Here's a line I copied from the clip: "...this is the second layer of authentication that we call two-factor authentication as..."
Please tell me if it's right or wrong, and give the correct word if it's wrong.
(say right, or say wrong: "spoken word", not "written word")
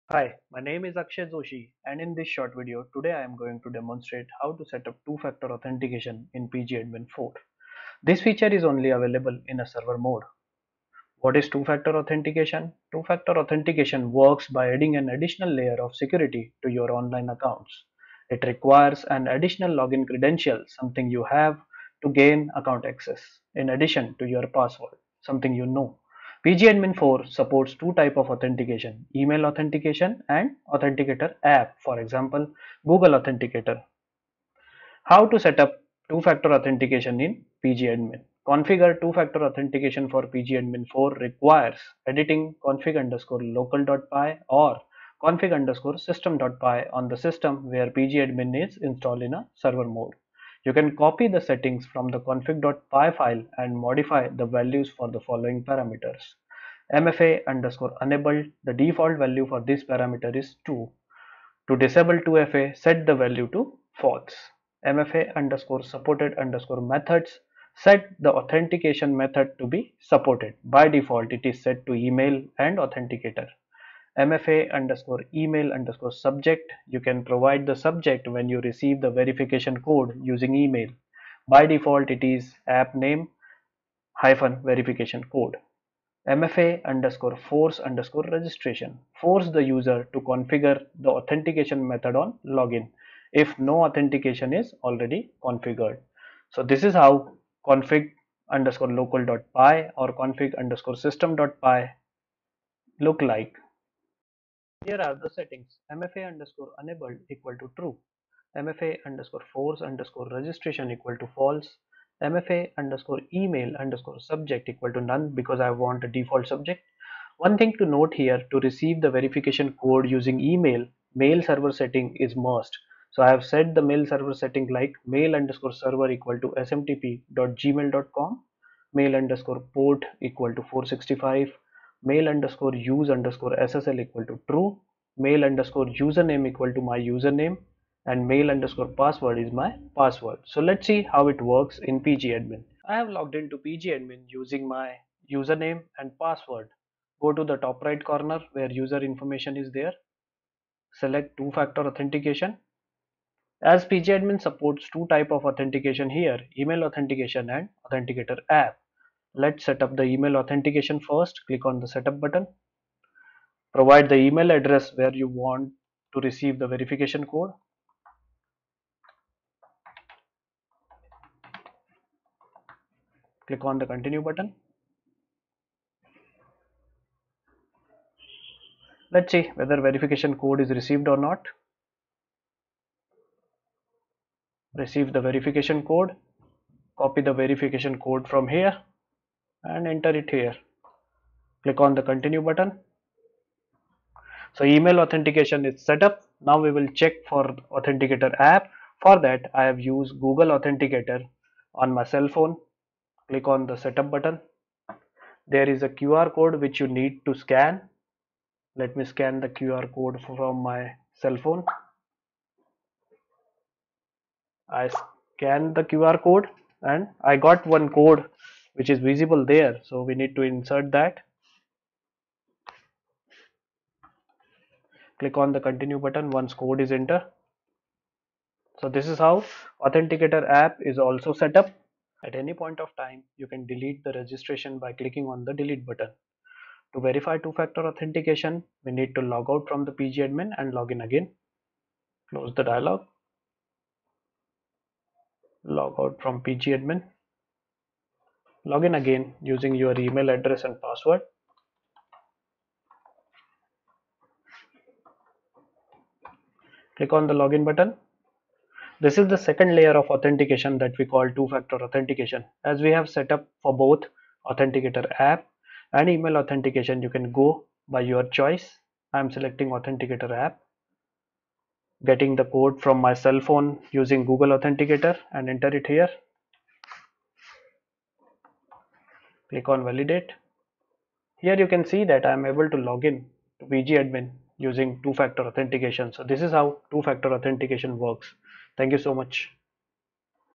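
right.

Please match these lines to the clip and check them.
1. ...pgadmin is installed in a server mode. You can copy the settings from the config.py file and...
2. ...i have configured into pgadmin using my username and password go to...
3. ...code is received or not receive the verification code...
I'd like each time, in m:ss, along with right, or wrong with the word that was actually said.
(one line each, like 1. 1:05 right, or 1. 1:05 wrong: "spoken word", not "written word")
1. 0:47 right
2. 2:22 wrong: "logged", not "configured"
3. 3:00 right.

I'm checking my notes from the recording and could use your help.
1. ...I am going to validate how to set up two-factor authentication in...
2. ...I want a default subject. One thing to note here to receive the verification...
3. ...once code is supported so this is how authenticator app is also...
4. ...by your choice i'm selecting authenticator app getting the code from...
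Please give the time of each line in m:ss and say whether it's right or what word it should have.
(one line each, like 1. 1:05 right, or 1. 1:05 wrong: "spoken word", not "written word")
1. 0:03 wrong: "demonstrate", not "validate"
2. 1:55 right
3. 3:46 wrong: "entered", not "supported"
4. 4:27 right.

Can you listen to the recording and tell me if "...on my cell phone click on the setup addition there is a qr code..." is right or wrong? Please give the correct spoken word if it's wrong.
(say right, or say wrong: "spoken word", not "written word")
wrong: "button", not "addition".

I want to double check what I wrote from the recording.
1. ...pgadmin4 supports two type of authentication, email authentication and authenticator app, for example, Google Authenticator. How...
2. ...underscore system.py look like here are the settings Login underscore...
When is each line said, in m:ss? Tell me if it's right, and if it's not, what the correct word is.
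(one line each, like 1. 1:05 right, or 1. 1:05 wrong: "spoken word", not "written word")
1. 0:26 right
2. 1:40 wrong: "MFA", not "Login".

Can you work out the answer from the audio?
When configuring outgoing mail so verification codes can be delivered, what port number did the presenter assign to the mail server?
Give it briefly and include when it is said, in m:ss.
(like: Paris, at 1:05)
465, at 2:10.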